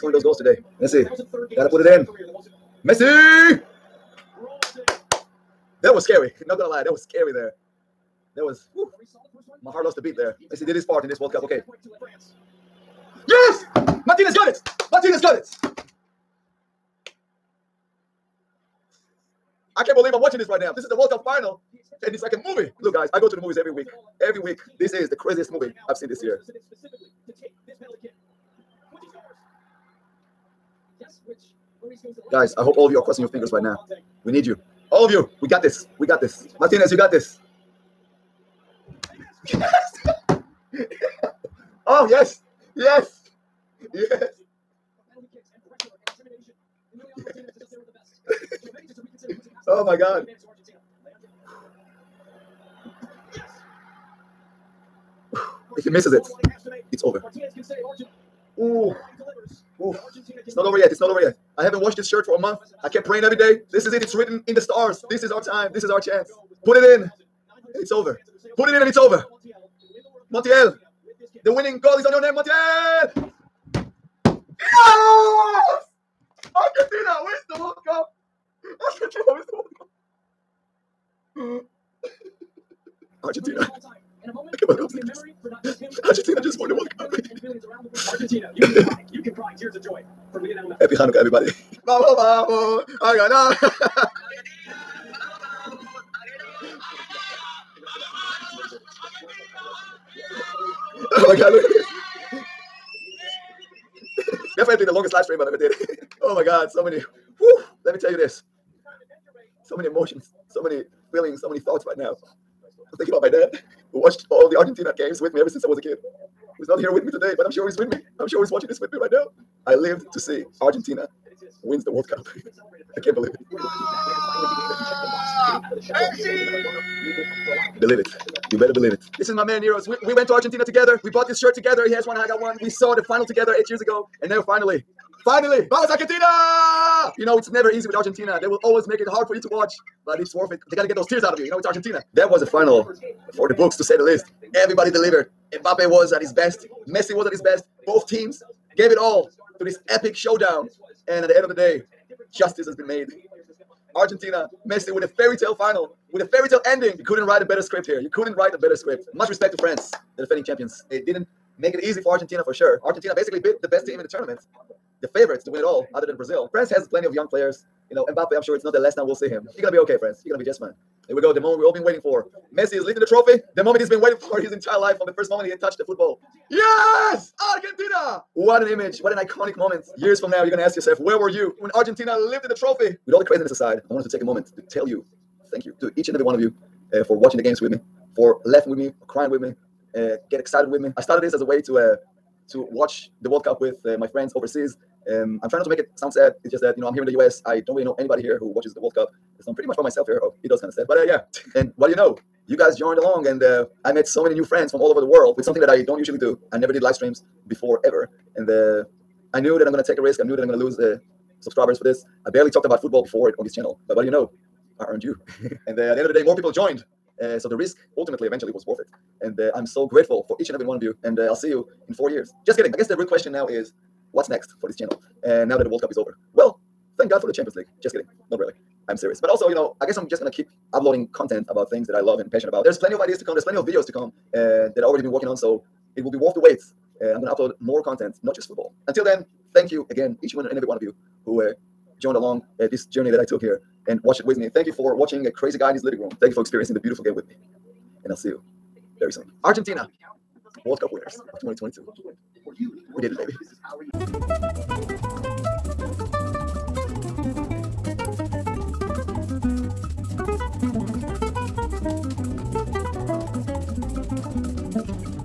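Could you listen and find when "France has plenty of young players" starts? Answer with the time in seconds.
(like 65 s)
166 s.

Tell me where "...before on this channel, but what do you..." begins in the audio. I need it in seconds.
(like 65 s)
213 s.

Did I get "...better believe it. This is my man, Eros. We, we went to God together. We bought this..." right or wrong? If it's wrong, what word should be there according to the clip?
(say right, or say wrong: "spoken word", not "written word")
wrong: "Argentina", not "God".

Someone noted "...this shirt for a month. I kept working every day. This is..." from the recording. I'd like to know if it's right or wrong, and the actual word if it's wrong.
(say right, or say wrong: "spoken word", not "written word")
wrong: "praying", not "working".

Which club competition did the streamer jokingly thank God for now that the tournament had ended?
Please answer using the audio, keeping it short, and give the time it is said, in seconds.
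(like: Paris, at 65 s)
Champions League, at 227 s.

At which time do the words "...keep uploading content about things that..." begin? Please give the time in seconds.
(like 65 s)
230 s.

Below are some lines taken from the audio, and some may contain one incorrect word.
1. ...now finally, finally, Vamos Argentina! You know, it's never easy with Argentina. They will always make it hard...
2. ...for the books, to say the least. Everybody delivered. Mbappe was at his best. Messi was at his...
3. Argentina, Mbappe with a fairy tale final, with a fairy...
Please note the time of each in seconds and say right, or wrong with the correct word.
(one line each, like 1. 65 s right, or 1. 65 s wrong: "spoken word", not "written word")
1. 134 s right
2. 143 s right
3. 153 s wrong: "Messi", not "Mbappe".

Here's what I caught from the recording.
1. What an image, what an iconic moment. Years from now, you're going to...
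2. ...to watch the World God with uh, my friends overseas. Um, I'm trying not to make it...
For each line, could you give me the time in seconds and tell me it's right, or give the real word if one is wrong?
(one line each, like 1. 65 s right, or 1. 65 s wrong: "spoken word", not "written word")
1. 178 s right
2. 192 s wrong: "Cup", not "God".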